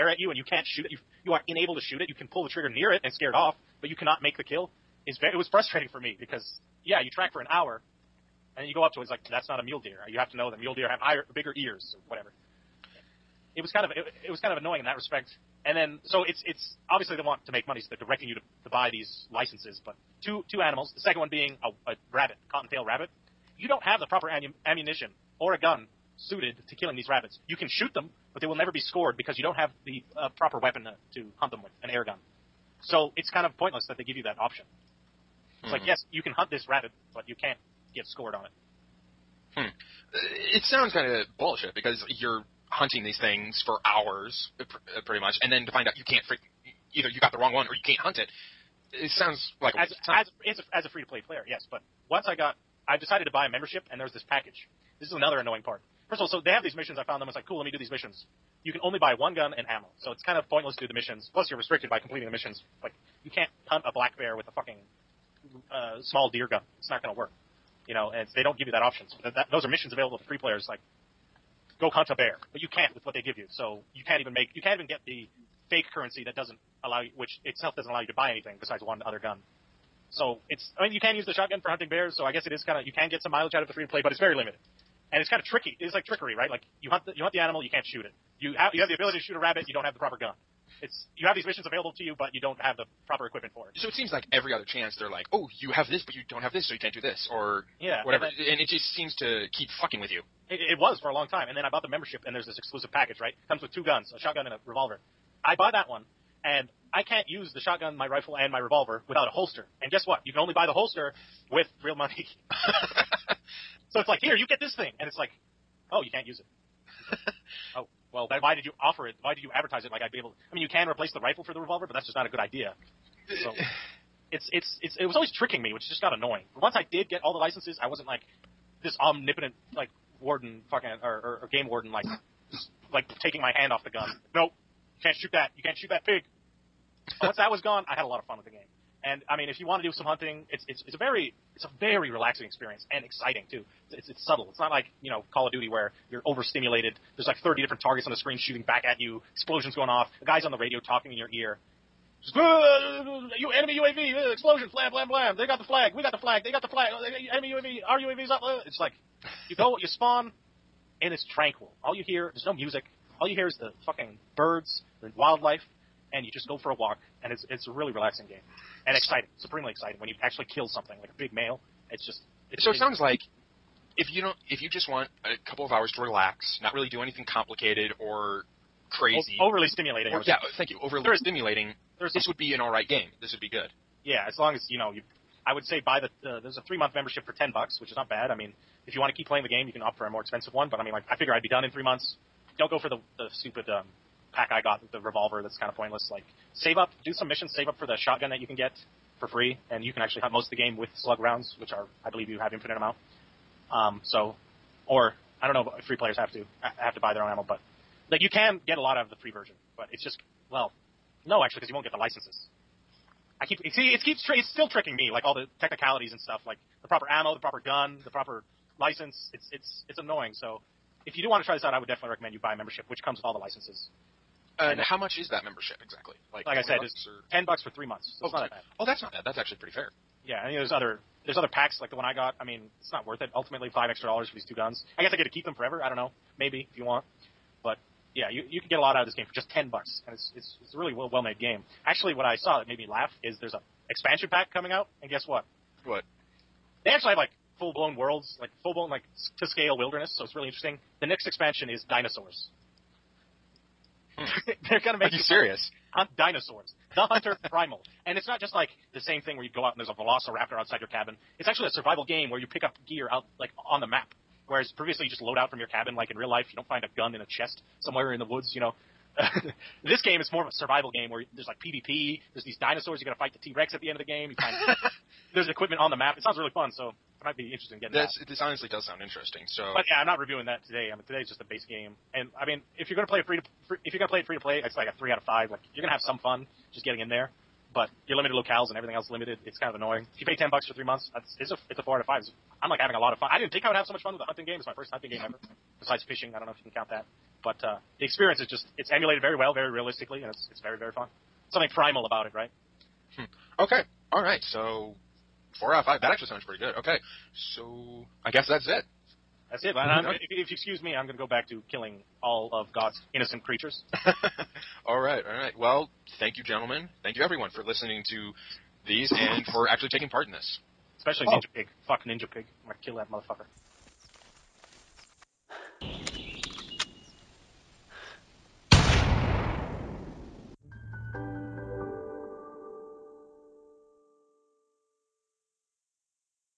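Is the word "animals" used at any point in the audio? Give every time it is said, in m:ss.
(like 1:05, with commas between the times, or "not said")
0:20, 1:27.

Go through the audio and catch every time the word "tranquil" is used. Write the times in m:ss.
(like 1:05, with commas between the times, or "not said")
2:41.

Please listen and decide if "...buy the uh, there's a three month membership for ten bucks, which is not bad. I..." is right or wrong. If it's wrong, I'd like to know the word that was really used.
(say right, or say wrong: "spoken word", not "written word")
right.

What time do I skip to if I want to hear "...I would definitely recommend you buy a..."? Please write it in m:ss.
3:41.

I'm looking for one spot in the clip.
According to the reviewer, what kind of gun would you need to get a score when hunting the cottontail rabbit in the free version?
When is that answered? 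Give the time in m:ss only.
0:31.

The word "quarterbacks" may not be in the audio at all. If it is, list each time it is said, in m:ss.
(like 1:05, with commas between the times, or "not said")
not said.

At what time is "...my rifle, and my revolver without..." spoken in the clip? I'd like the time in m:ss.
1:47.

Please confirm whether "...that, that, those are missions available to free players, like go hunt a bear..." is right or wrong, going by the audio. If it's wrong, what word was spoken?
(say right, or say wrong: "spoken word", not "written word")
right.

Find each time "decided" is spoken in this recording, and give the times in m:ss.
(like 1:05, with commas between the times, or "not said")
0:52.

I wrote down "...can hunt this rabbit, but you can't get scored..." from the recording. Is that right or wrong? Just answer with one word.
right.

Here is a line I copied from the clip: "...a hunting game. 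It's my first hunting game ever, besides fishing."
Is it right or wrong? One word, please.
right.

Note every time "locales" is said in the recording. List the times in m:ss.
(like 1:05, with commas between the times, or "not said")
4:48.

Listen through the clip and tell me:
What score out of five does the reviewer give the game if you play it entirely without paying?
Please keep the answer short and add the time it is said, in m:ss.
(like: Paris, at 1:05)
3 out of 5, at 4:44.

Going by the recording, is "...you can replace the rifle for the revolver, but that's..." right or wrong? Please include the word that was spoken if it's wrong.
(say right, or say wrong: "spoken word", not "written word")
right.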